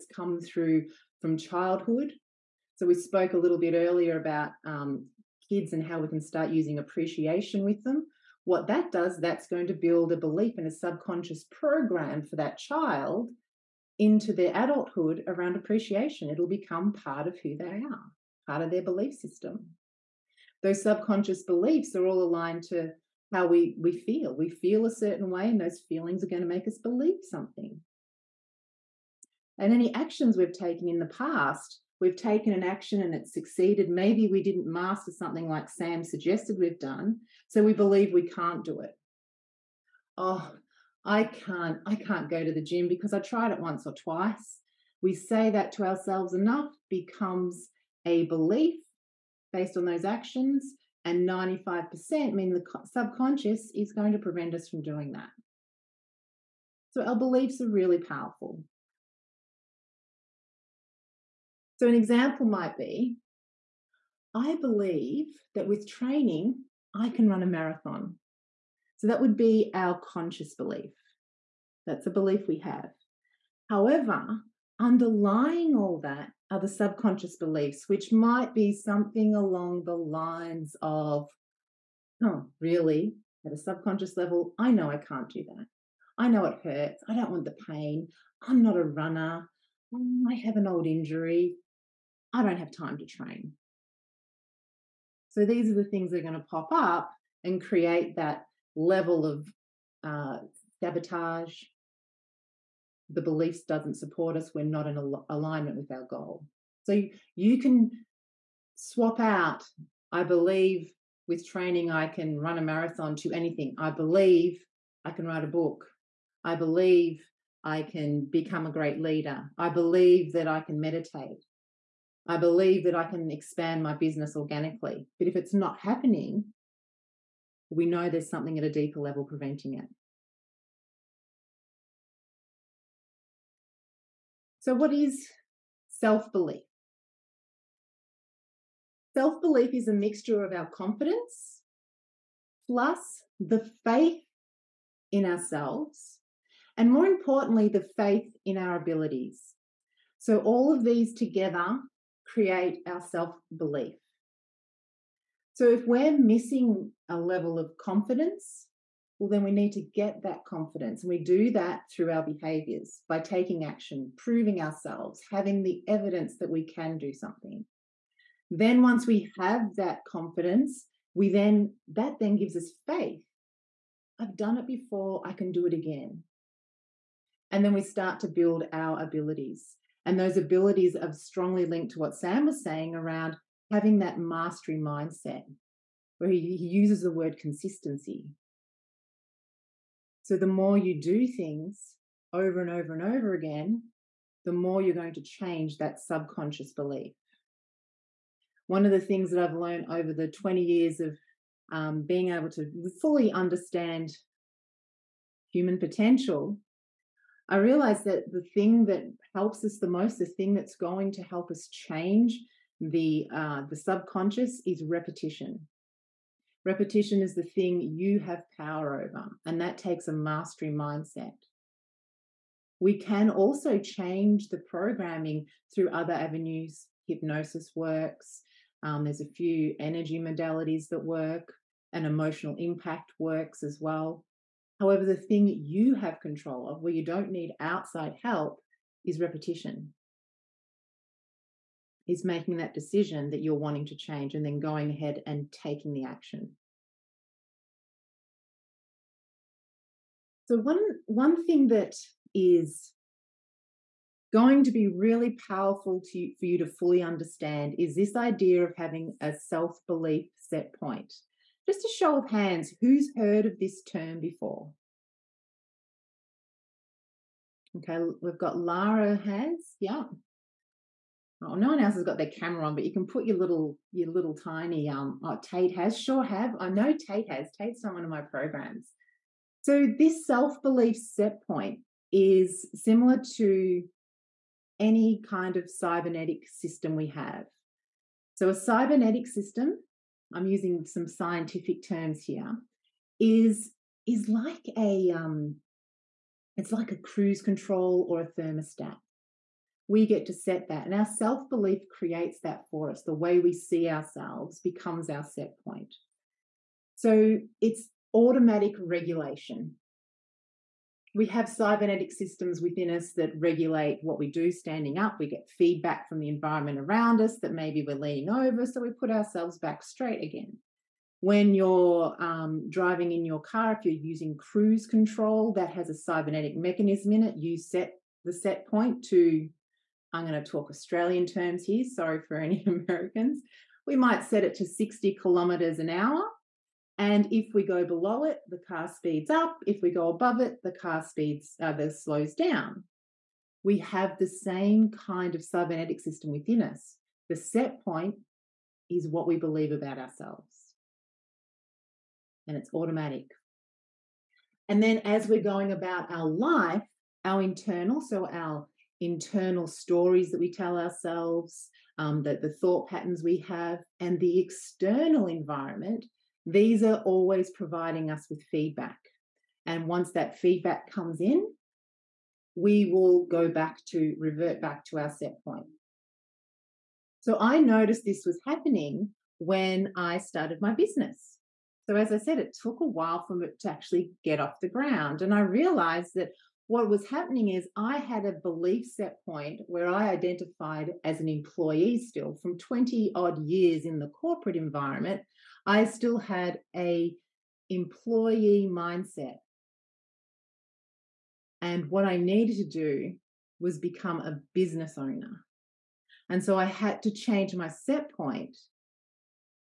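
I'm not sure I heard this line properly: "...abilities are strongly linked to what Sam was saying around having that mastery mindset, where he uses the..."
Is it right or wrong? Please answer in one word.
right.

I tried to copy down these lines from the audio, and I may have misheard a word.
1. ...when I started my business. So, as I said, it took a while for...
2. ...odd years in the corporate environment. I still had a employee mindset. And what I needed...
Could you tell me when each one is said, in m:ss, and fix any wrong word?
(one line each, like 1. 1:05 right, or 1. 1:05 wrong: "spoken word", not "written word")
1. 6:19 right
2. 6:33 right.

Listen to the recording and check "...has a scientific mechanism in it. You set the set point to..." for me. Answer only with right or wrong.
wrong.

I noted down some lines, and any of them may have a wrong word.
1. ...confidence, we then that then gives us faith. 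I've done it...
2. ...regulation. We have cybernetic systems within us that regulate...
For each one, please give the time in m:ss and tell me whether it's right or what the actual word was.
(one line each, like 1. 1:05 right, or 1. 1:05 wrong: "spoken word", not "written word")
1. 2:50 right
2. 5:08 right.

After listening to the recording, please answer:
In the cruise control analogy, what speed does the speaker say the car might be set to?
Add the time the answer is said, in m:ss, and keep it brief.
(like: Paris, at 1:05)
60 kilometers an hour, at 5:34.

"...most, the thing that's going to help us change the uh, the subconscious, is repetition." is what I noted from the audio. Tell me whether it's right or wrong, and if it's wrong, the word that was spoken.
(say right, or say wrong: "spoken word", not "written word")
right.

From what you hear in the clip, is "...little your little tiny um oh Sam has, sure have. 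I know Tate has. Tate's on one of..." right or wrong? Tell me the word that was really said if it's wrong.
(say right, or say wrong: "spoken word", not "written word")
wrong: "Tate", not "Sam".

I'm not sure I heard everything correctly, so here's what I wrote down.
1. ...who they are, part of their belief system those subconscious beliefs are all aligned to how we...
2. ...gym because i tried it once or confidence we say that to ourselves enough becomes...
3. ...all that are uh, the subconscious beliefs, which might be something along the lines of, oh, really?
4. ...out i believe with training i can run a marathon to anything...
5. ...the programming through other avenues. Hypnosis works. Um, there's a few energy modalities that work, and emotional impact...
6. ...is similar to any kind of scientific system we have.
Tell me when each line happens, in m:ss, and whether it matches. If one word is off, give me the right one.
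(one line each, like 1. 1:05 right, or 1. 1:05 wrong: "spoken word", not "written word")
1. 0:17 right
2. 0:42 wrong: "twice", not "confidence"
3. 1:15 right
4. 1:49 right
5. 3:44 right
6. 4:42 wrong: "cybernetic", not "scientific".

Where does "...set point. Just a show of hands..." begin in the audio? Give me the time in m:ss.
4:20.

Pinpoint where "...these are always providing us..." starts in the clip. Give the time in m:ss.
6:06.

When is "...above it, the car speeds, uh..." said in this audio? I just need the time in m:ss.
5:40.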